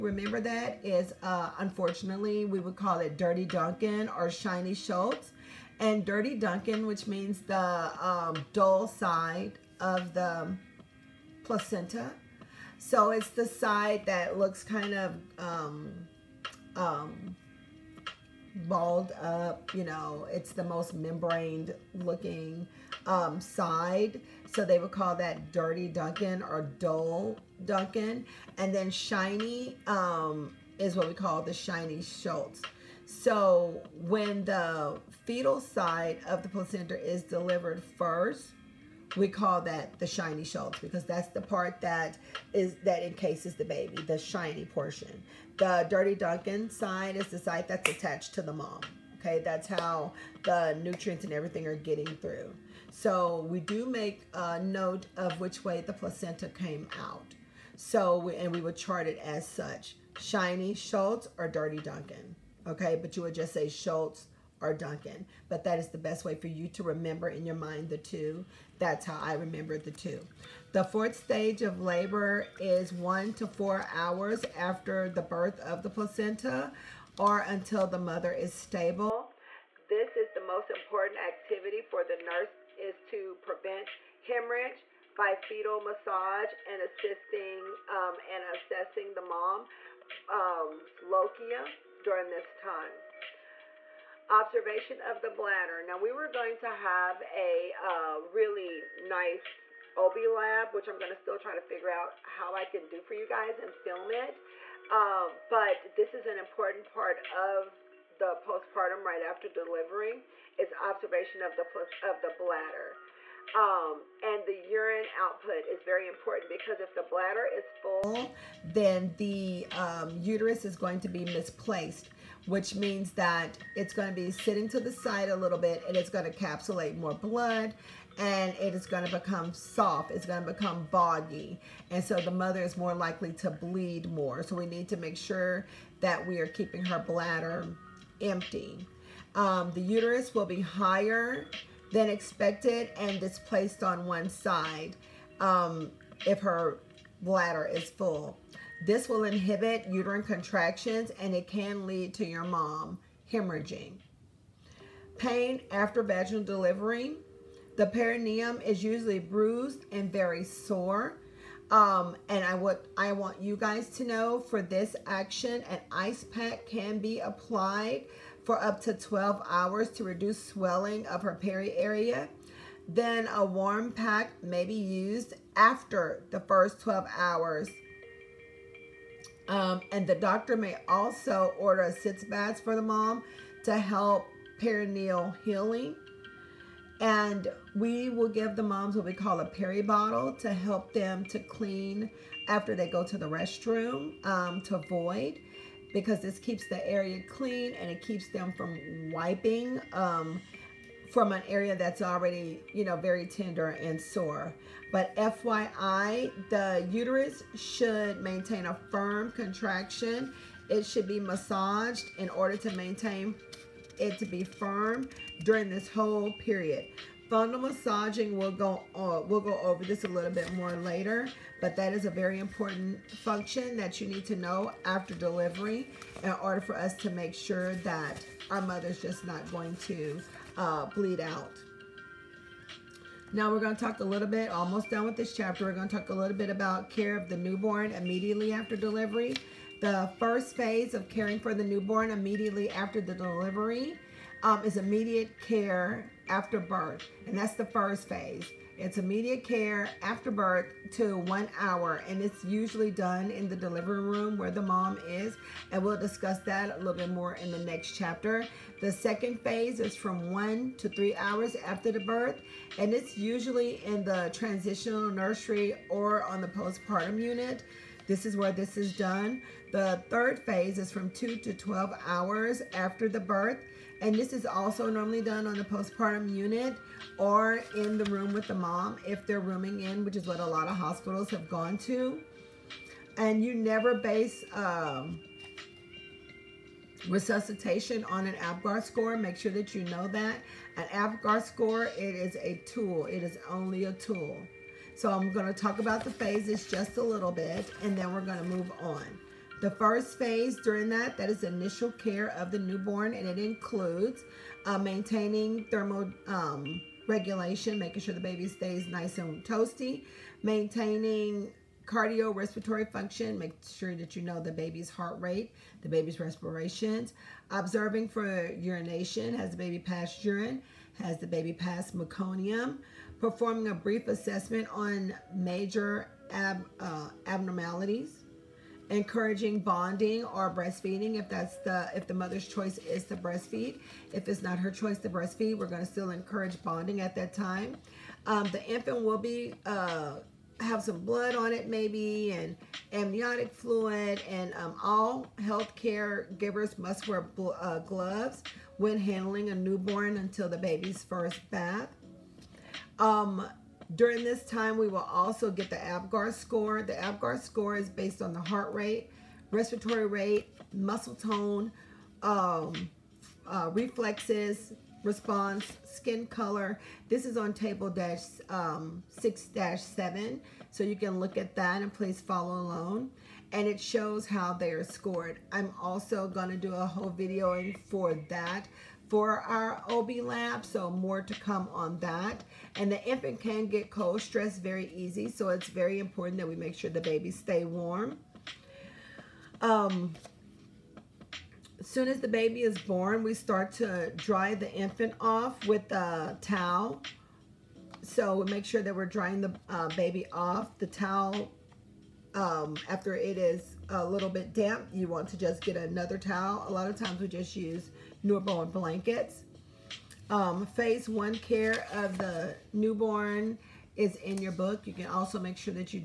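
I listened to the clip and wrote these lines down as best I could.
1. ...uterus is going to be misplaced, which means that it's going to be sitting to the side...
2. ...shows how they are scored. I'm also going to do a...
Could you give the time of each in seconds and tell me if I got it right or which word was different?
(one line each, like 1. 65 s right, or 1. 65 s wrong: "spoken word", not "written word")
1. 120 s right
2. 373 s right.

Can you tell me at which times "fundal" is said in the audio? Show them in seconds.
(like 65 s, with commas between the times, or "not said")
85 s, 217 s.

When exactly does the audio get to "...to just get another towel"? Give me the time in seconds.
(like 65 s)
405 s.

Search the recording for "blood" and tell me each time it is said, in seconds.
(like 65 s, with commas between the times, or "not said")
127 s, 340 s.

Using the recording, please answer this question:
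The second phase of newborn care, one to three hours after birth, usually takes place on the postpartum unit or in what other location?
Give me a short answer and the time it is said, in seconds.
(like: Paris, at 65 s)
transitional nursery, at 264 s.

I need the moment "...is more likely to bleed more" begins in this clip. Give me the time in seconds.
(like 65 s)
132 s.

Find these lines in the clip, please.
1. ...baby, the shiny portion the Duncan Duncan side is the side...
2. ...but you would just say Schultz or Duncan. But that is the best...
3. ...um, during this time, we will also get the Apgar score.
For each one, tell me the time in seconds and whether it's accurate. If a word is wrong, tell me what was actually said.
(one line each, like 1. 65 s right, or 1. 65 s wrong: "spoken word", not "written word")
1. 43 s wrong: "Dirty", not "Duncan"
2. 63 s right
3. 352 s right.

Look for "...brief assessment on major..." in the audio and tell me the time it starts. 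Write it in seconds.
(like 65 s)
323 s.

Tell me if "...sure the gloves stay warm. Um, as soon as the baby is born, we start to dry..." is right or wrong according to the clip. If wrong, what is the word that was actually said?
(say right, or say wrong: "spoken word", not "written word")
wrong: "babies", not "gloves".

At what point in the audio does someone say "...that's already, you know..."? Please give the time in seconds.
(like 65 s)
201 s.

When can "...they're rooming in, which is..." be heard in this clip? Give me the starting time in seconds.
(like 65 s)
279 s.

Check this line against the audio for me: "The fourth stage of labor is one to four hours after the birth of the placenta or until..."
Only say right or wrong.
right.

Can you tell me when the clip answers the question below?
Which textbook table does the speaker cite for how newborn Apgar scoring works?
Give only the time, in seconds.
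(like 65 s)
369 s.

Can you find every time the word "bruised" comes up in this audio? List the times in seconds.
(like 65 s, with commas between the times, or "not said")
159 s.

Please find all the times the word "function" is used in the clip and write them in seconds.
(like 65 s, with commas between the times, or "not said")
223 s, 312 s.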